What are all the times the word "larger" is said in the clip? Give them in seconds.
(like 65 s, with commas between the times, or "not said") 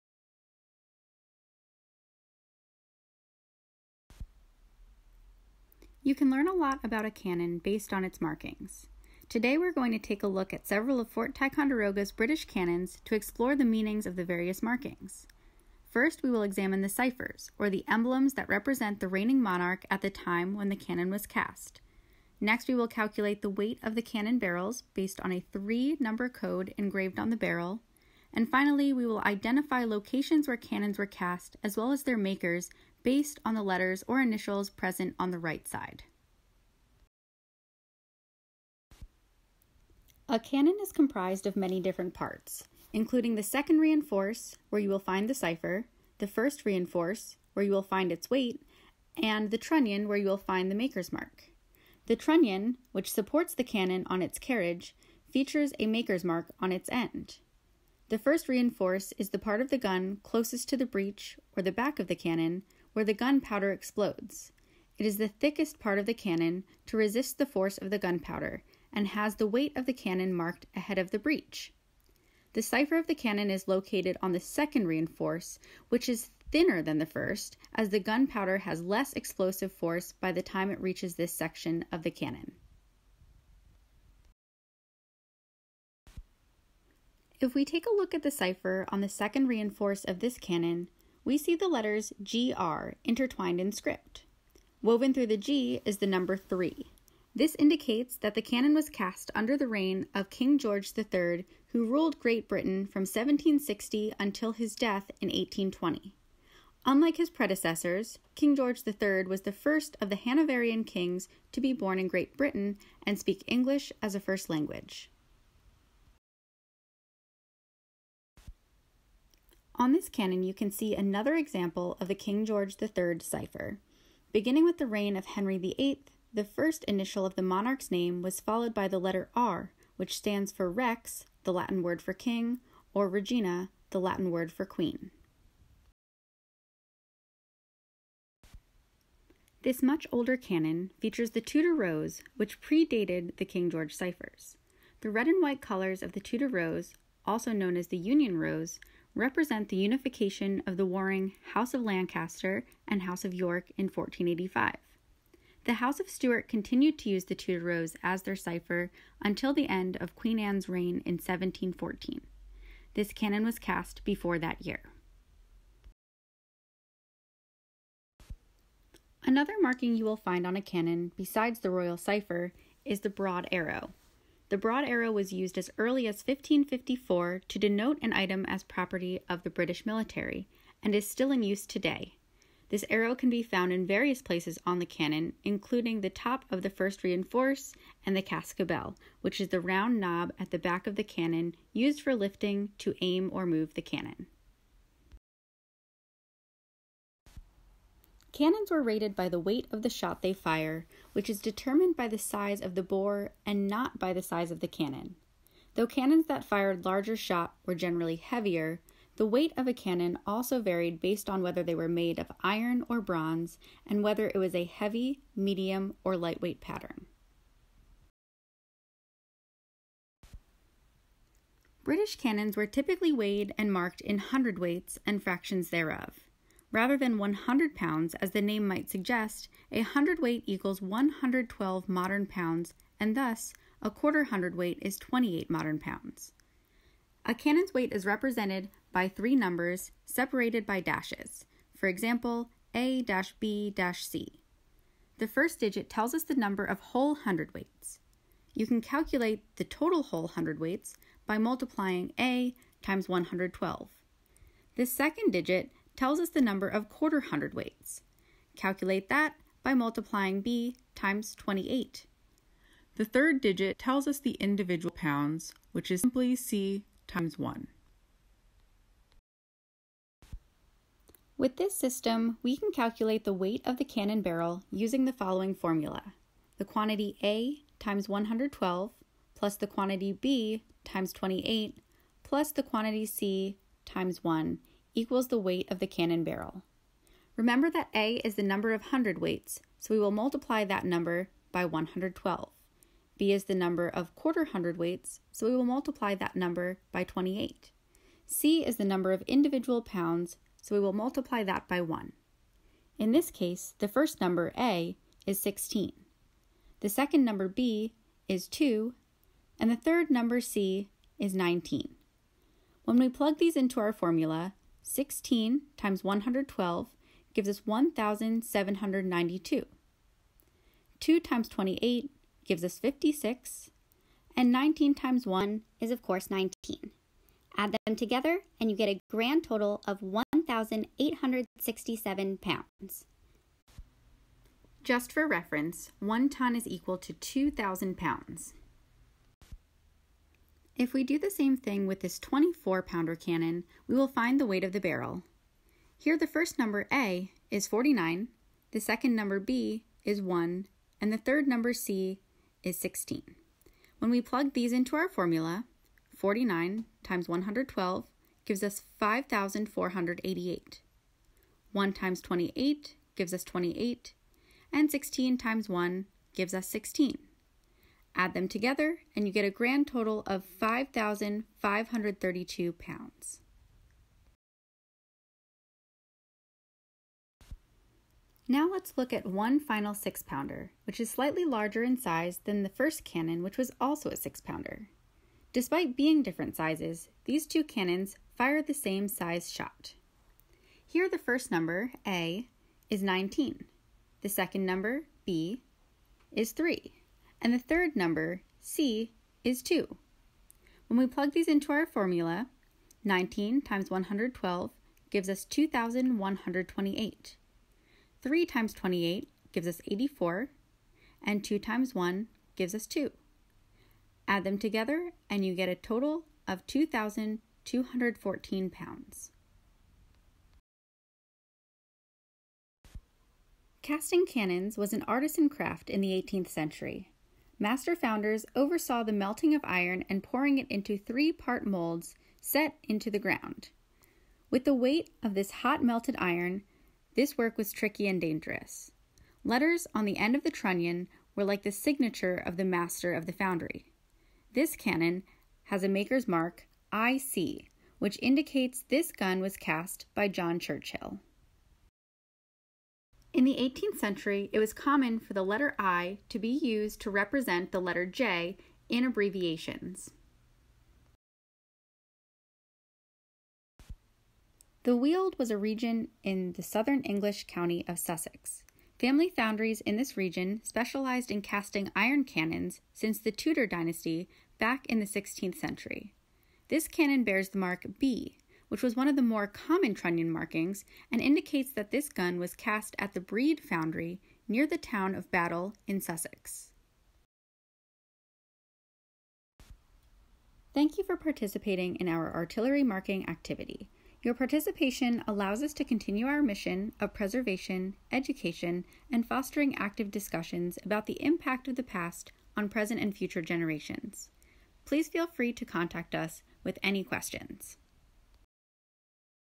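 206 s, 381 s.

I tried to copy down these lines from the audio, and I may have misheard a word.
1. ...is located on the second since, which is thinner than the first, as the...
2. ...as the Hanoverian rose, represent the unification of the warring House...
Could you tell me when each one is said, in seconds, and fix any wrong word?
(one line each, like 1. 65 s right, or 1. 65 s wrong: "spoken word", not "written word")
1. 73 s wrong: "reinforce", not "since"
2. 147 s wrong: "Union", not "Hanoverian".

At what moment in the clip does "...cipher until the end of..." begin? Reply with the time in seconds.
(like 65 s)
158 s.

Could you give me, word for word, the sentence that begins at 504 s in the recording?
Please feel free to contact us with any questions.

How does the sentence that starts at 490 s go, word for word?
Thank you for participating in our artillery marking activity.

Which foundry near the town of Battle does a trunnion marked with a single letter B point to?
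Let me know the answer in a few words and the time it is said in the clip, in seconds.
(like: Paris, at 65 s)
Brede Foundry, at 483 s.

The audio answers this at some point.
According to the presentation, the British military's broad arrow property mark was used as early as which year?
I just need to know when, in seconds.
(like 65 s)
176 s.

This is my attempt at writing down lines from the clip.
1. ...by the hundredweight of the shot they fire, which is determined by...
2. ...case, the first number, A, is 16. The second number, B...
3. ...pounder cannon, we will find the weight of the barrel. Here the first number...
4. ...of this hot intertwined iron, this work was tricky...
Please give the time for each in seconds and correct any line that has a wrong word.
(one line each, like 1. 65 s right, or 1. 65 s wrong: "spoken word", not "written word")
1. 199 s wrong: "weight", not "hundredweight"
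2. 303 s right
3. 342 s right
4. 435 s wrong: "melted", not "intertwined".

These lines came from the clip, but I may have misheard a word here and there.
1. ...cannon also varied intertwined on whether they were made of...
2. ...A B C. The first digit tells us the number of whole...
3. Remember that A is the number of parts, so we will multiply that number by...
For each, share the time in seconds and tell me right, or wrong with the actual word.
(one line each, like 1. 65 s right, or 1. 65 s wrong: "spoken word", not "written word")
1. 209 s wrong: "based", not "intertwined"
2. 242 s right
3. 287 s wrong: "hundredweights", not "parts".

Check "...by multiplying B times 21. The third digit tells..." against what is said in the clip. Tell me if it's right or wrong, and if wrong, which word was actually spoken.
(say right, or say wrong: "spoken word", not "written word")
wrong: "28", not "21".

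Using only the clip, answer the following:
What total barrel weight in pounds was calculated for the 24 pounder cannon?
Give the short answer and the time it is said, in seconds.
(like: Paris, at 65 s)
5,532 pounds, at 370 s.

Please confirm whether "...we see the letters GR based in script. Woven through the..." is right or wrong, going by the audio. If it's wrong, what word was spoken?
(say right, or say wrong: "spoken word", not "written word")
wrong: "intertwined", not "based".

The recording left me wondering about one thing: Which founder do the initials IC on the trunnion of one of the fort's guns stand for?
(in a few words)
John Churchill.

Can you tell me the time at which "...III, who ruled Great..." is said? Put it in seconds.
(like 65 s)
100 s.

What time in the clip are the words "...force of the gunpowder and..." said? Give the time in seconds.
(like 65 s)
67 s.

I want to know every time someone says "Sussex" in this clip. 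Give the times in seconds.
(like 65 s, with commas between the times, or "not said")
467 s, 485 s.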